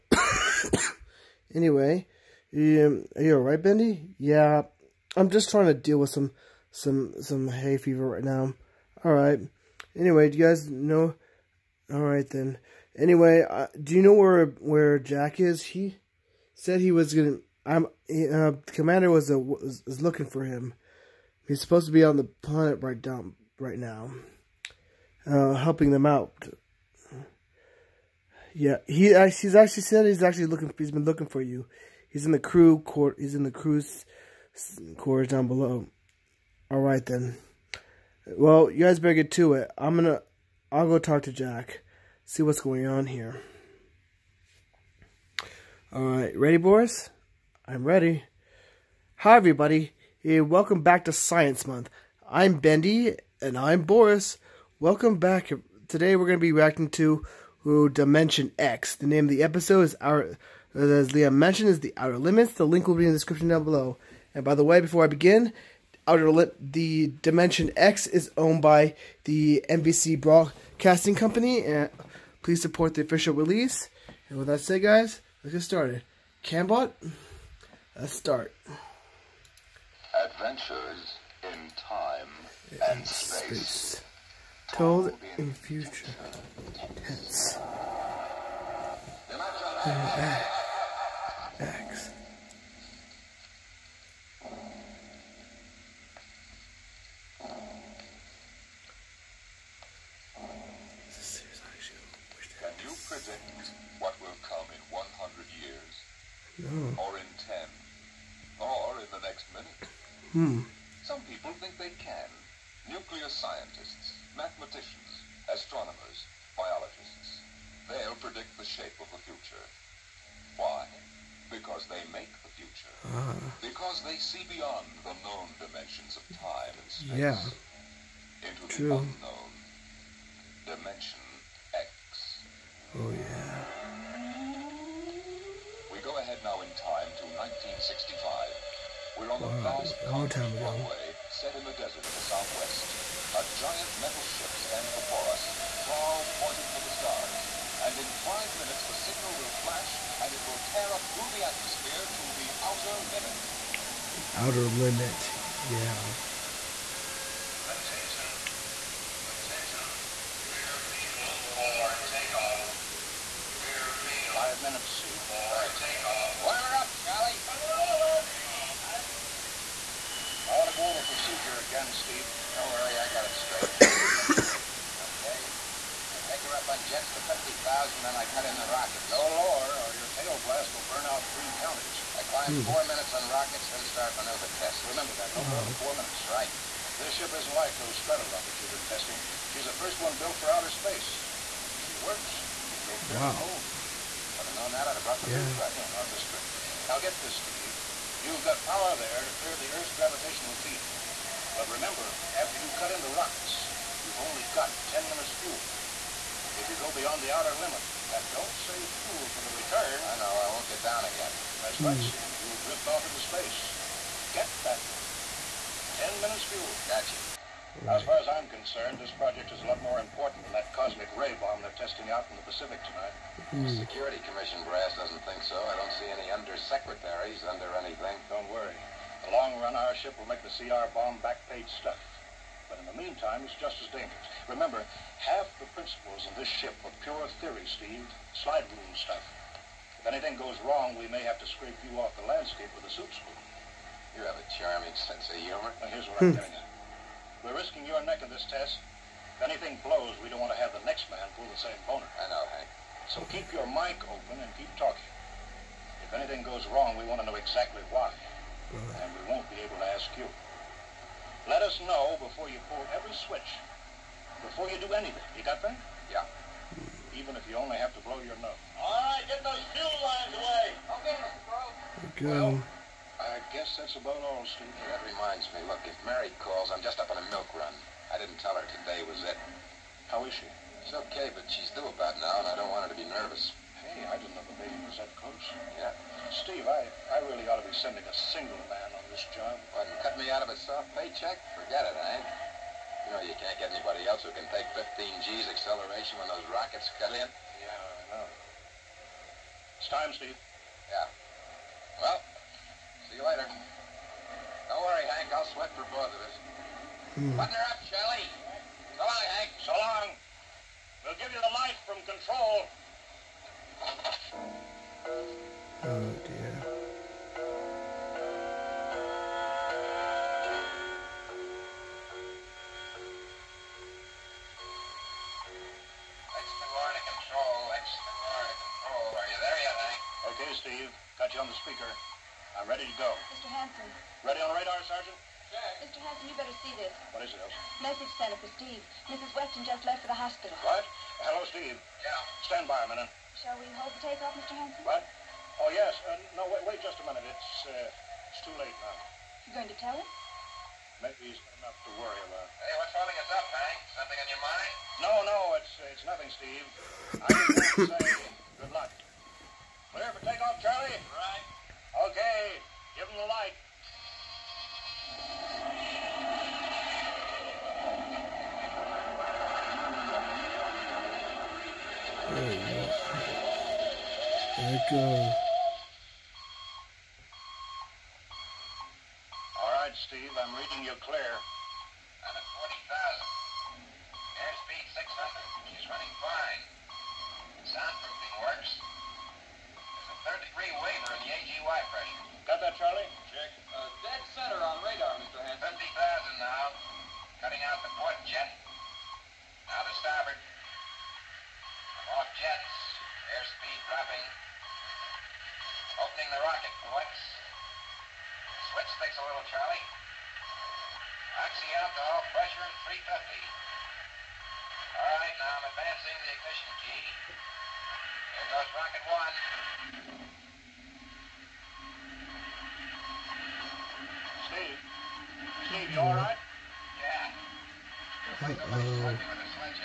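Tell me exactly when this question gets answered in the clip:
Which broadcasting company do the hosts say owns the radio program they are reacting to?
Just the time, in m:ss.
1:09.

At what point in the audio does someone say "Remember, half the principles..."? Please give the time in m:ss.
3:54.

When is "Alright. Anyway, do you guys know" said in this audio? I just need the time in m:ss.
0:09.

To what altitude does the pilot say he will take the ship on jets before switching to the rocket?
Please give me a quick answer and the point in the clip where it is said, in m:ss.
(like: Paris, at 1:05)
50,000, at 2:57.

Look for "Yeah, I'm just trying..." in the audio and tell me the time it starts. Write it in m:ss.
0:04.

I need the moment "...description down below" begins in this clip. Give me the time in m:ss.
1:03.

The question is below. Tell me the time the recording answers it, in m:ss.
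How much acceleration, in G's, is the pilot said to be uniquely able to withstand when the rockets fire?
4:54.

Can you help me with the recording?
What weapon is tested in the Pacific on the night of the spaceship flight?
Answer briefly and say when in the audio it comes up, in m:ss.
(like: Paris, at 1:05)
cosmic ray bomb, at 3:40.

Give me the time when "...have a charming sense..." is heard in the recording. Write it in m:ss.
4:04.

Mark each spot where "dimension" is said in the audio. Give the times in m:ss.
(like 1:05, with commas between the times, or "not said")
0:57, 1:07, 2:05, 2:10.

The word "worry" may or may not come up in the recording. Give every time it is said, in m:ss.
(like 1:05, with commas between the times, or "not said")
2:52, 3:48, 5:04, 5:52.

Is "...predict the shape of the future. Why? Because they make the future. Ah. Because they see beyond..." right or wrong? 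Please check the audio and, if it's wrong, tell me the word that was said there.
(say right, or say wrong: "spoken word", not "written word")
right.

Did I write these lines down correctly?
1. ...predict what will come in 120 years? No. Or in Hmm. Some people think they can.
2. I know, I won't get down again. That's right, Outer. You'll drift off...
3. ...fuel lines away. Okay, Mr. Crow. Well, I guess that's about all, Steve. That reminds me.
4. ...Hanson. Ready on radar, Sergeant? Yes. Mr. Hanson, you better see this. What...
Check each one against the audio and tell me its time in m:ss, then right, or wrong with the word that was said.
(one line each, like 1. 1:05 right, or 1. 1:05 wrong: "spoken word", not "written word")
1. 1:43 wrong: "100", not "120"
2. 3:30 wrong: "Steve", not "Outer"
3. 4:29 right
4. 5:33 right.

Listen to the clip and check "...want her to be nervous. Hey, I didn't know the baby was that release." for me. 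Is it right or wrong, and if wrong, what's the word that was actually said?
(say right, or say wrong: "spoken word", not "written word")
wrong: "close", not "release".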